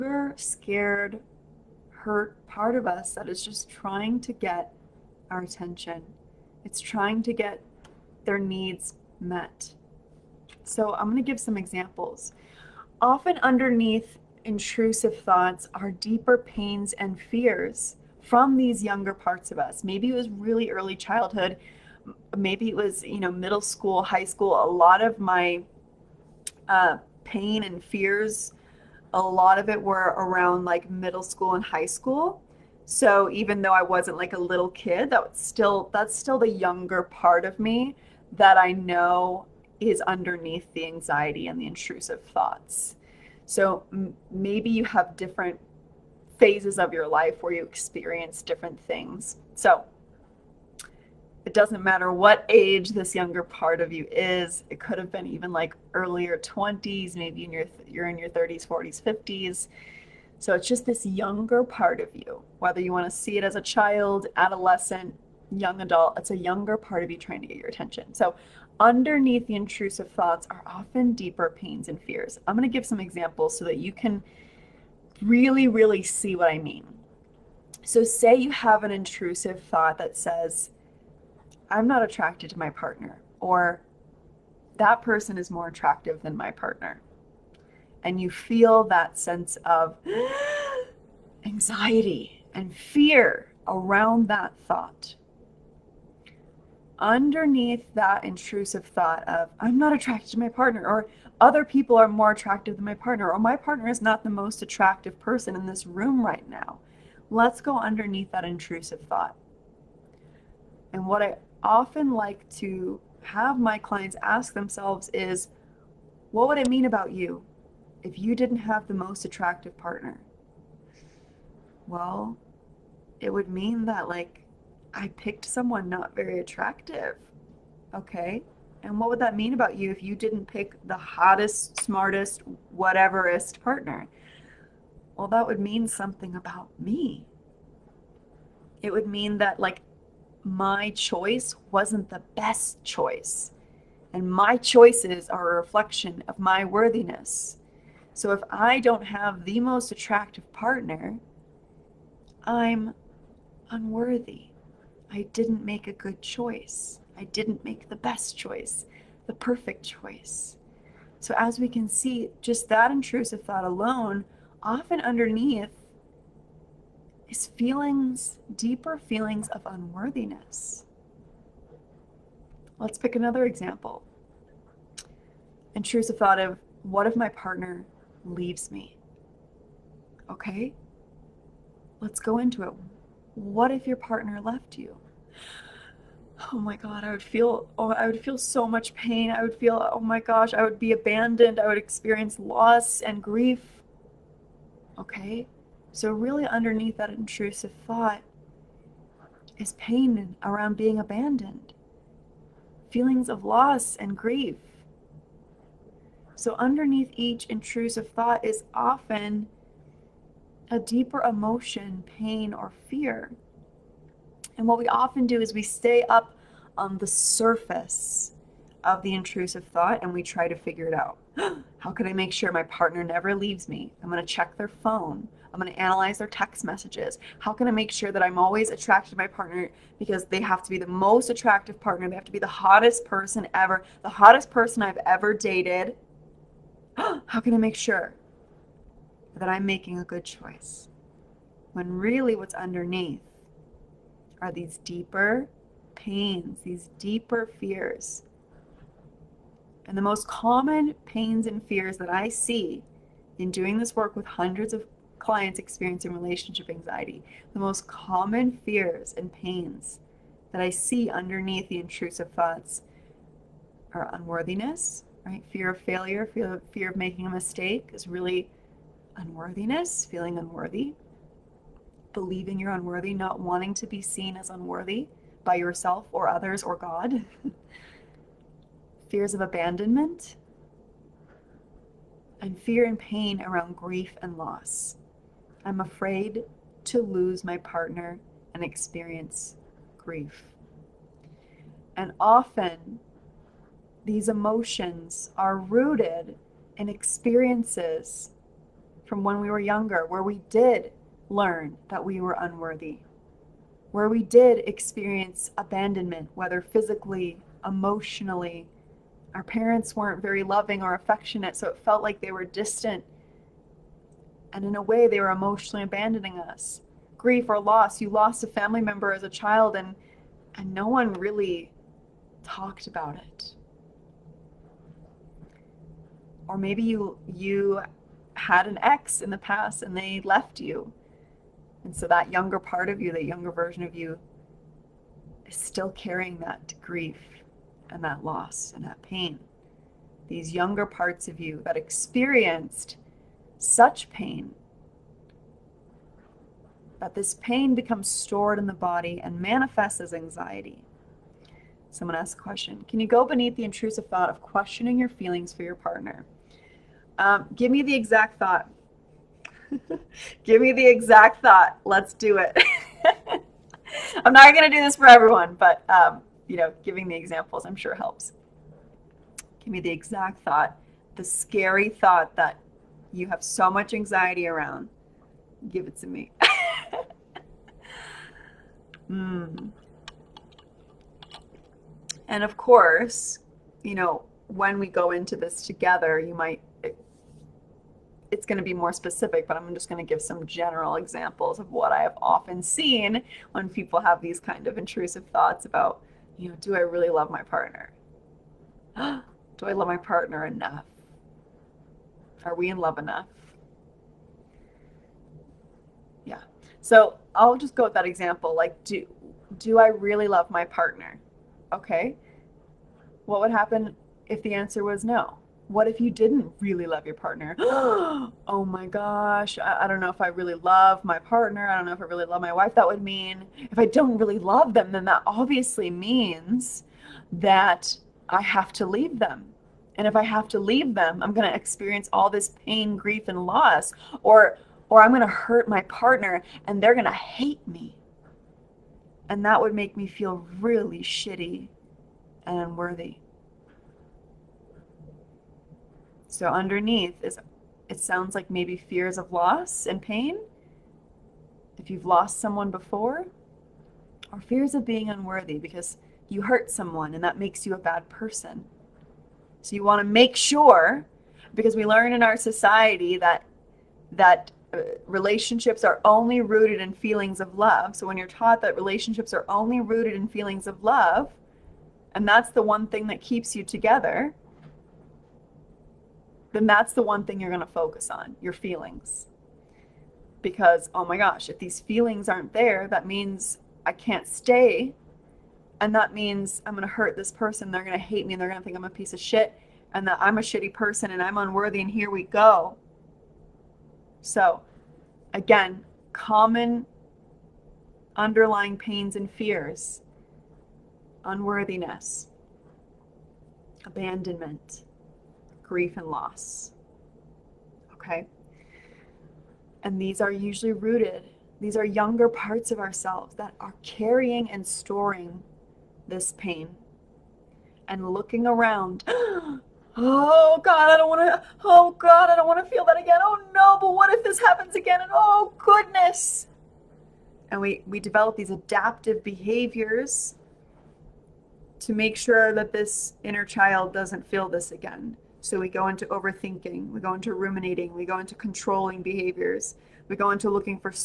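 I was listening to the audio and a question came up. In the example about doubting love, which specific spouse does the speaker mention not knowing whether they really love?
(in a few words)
wife.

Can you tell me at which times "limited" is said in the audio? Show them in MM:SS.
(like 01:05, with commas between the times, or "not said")
not said.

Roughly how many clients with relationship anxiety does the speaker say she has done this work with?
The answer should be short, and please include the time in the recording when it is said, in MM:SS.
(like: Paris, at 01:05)
hundreds, at 04:14.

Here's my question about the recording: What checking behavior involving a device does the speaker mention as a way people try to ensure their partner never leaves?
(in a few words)
check their phone.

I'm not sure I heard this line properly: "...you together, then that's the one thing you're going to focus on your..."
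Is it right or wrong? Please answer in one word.
right.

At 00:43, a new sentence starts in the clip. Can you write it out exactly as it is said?
So m- maybe you have different phases of your life where you experience different things.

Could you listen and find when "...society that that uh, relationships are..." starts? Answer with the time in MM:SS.
07:42.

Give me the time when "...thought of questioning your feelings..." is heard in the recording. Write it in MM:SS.
05:54.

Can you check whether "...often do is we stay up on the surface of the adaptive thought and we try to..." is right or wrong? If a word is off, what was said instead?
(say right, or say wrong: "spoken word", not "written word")
wrong: "intrusive", not "adaptive".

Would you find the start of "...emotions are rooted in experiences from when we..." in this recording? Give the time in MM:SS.
04:54.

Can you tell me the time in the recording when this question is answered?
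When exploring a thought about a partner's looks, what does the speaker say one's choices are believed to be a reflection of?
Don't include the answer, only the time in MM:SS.
02:24.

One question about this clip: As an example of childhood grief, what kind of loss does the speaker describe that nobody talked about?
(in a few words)
a family member.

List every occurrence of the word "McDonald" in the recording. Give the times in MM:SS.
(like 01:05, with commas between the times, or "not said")
not said.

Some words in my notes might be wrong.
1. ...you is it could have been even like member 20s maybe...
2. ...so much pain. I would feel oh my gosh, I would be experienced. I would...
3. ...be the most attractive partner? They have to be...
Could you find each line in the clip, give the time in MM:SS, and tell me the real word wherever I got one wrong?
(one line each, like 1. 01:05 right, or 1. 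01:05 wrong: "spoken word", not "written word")
1. 00:53 wrong: "earlier", not "member"
2. 03:08 wrong: "abandoned", not "experienced"
3. 03:50 right.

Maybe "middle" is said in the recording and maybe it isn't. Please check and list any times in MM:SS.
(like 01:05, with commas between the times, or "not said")
00:23, 00:30.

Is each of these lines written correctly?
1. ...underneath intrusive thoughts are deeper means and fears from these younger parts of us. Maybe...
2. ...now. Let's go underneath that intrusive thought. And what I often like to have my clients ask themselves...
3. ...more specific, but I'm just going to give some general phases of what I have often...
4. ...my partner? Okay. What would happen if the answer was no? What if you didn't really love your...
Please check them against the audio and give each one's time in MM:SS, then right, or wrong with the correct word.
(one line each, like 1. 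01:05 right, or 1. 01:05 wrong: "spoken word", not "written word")
1. 00:13 wrong: "pains", not "means"
2. 01:46 right
3. 06:28 wrong: "examples", not "phases"
4. 06:50 right.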